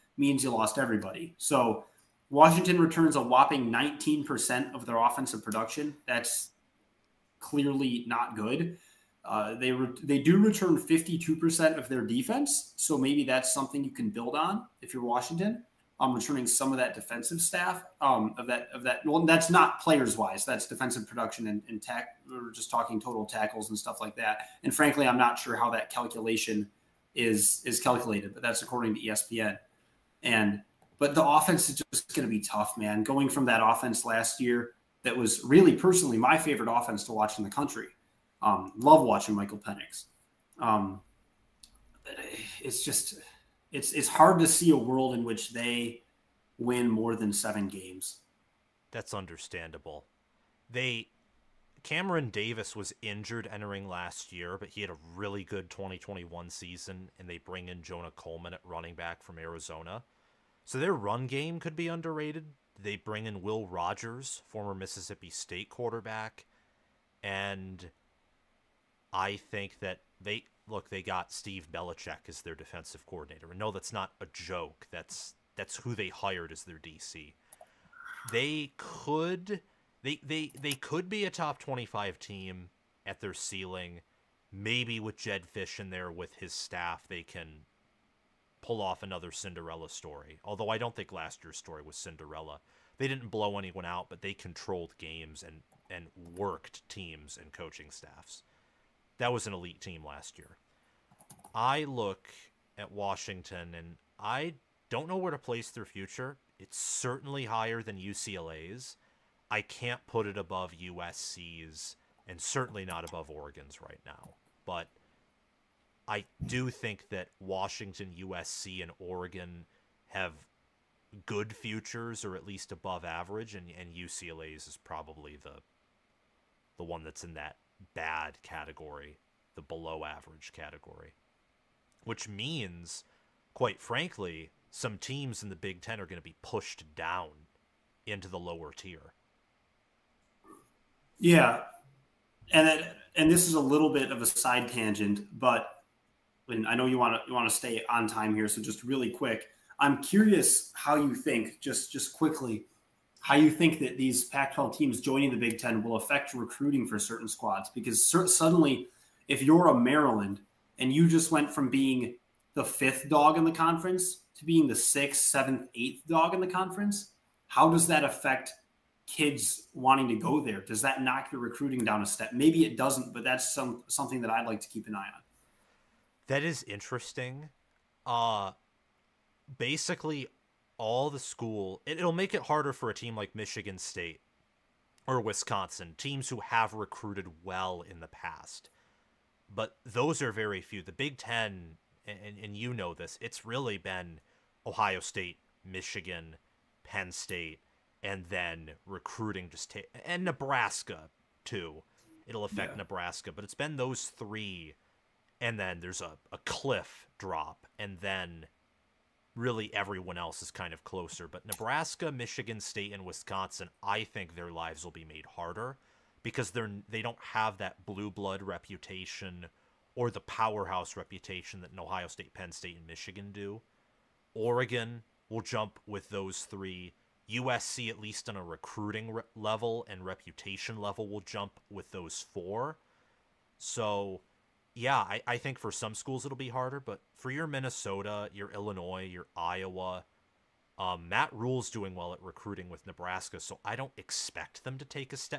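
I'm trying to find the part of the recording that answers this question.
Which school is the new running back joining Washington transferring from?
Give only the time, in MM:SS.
00:59.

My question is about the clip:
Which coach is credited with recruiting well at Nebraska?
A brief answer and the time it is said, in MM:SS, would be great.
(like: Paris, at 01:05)
Matt Rhule, at 04:01.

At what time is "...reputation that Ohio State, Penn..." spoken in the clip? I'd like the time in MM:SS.
03:40.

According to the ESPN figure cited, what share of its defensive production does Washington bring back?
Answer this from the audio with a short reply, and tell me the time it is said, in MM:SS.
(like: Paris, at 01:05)
52%, at 00:10.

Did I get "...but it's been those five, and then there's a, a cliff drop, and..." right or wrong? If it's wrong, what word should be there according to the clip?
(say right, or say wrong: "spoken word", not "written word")
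wrong: "three", not "five".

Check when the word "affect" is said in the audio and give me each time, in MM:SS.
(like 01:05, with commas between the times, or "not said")
02:35, 02:48, 03:22.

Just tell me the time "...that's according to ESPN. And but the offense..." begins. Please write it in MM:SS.
00:28.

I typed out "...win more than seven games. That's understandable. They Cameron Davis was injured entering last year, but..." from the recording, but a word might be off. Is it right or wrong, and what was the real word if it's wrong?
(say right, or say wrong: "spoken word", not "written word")
right.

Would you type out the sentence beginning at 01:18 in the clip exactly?
They could they they they could be a top 25 team at their ceiling.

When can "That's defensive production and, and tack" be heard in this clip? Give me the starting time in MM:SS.
00:20.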